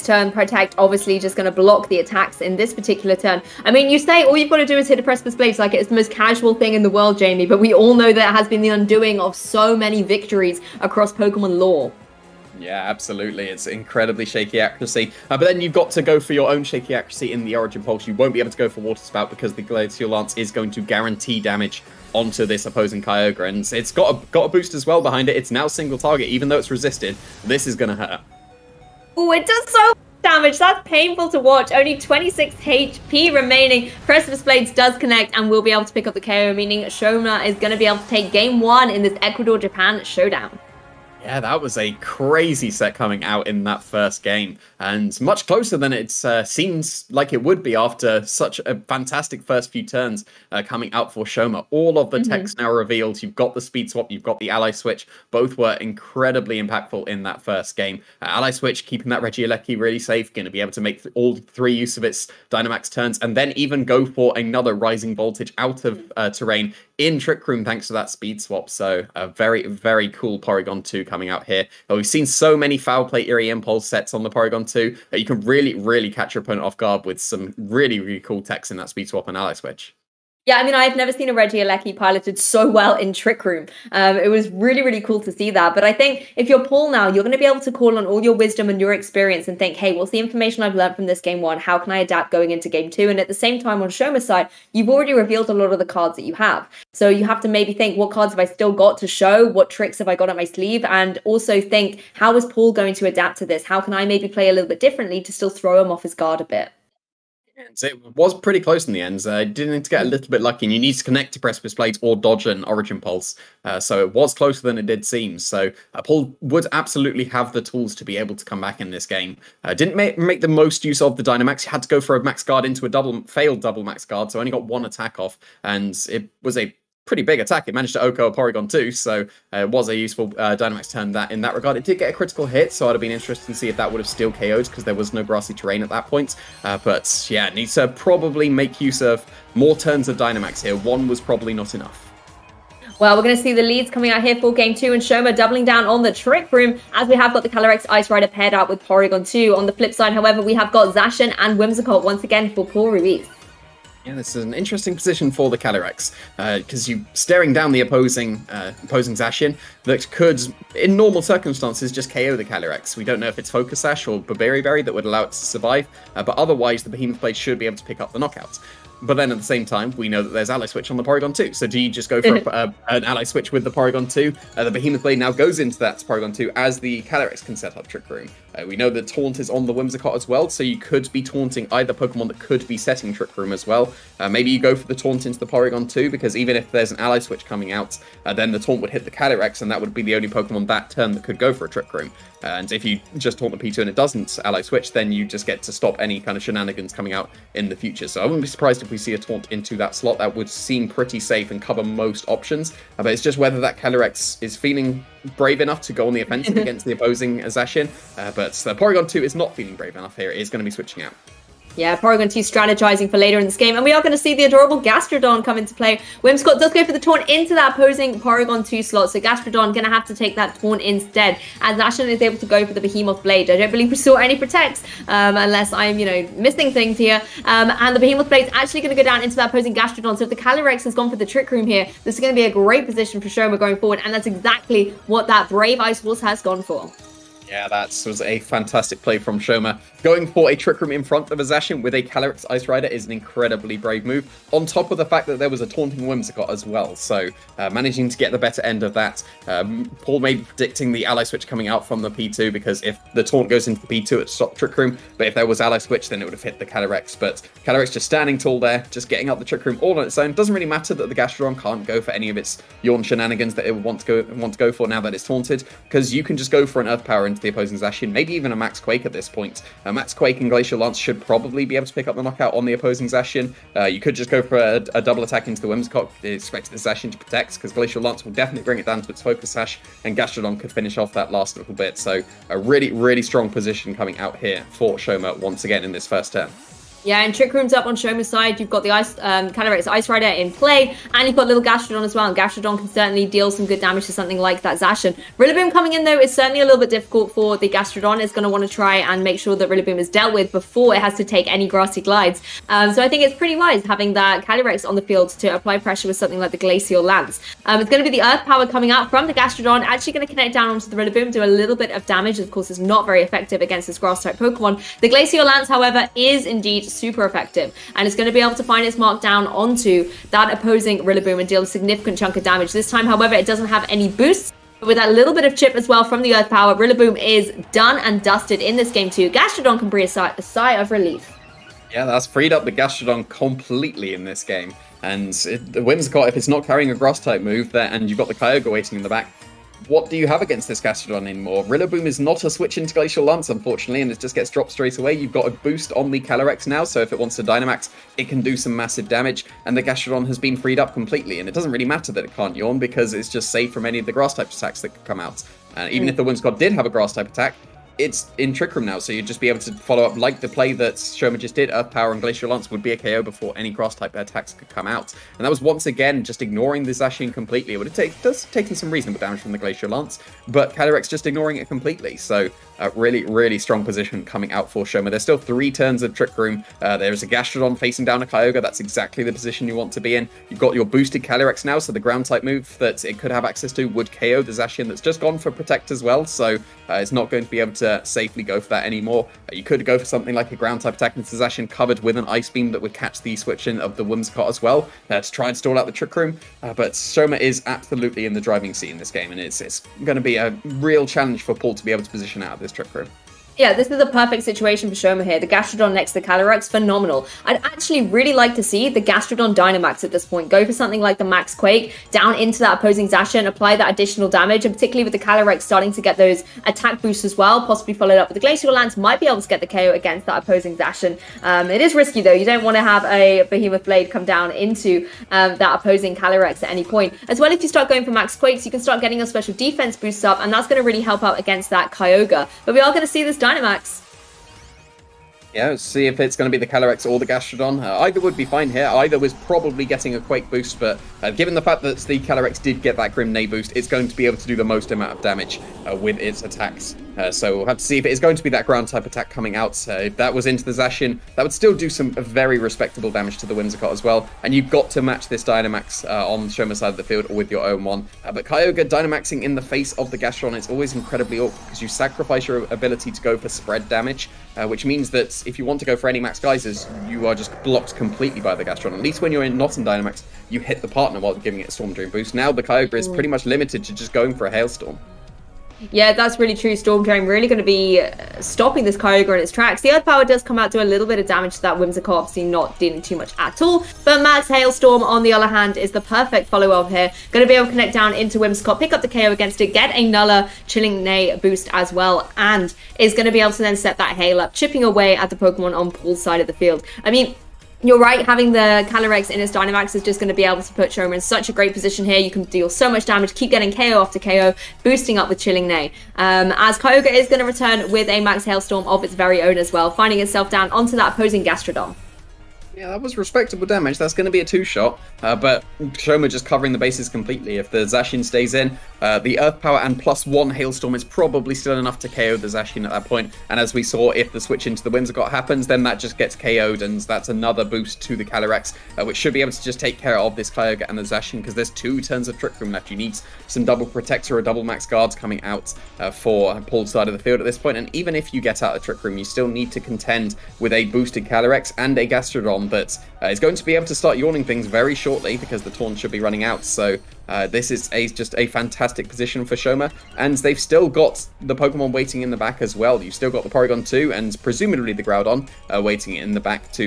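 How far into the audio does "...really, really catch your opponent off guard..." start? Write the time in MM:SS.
01:15.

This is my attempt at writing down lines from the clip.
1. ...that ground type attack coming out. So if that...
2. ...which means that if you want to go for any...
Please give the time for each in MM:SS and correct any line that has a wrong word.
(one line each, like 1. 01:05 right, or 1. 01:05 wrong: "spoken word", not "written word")
1. 07:28 right
2. 07:44 right.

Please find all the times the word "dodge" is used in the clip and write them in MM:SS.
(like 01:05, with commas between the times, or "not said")
01:52.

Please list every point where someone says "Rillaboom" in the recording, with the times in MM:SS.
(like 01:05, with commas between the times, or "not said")
04:55, 04:59, 05:10, 05:20, 05:26, 05:41.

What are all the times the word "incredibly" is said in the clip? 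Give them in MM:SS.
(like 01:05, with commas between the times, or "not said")
00:13, 00:55, 04:03, 07:40.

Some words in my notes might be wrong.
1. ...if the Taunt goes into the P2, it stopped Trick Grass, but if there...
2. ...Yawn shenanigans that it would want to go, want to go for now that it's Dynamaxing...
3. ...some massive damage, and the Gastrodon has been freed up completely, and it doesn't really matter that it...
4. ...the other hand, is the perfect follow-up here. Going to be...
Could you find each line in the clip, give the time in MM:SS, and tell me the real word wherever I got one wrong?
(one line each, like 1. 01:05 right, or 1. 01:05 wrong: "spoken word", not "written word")
1. 04:12 wrong: "Room", not "Grass"
2. 04:22 wrong: "Taunted", not "Dynamaxing"
3. 05:48 right
4. 08:05 right.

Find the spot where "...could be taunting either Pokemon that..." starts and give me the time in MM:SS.
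03:00.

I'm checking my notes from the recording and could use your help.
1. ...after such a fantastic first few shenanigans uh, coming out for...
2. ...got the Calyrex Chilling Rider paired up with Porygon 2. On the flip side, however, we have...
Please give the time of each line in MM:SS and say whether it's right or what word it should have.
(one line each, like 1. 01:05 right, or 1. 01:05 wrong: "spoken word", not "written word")
1. 00:47 wrong: "turns", not "shenanigans"
2. 02:27 wrong: "Ice", not "Chilling".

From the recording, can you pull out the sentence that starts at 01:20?
Yeah, I mean, I've never seen a Regieleki piloted so well in Trick Room.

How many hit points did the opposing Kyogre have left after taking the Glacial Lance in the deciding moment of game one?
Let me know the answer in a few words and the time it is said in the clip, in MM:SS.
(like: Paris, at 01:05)
26, at 00:31.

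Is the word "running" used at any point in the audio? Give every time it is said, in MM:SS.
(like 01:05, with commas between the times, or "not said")
09:06.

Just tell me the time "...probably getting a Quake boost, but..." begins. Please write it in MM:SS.
07:19.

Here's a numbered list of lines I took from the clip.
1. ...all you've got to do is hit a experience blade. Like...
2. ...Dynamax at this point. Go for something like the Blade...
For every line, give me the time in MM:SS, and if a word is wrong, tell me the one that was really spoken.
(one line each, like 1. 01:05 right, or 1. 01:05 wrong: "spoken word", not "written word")
1. 00:04 wrong: "precipice", not "experience"
2. 06:49 wrong: "Max", not "Blade".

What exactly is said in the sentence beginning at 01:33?
And at the same time, on Shoma's side, you've already revealed a lot of the cards that you have.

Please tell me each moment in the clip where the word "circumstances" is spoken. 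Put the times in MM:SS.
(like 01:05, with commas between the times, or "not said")
02:41.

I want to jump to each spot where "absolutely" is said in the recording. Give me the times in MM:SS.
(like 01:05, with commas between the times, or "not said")
00:12, 01:56, 06:37.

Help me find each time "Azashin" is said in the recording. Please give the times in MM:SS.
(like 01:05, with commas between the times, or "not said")
03:27, 04:01.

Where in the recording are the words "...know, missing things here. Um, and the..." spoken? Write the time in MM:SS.
03:46.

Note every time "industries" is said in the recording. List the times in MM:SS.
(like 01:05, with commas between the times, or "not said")
not said.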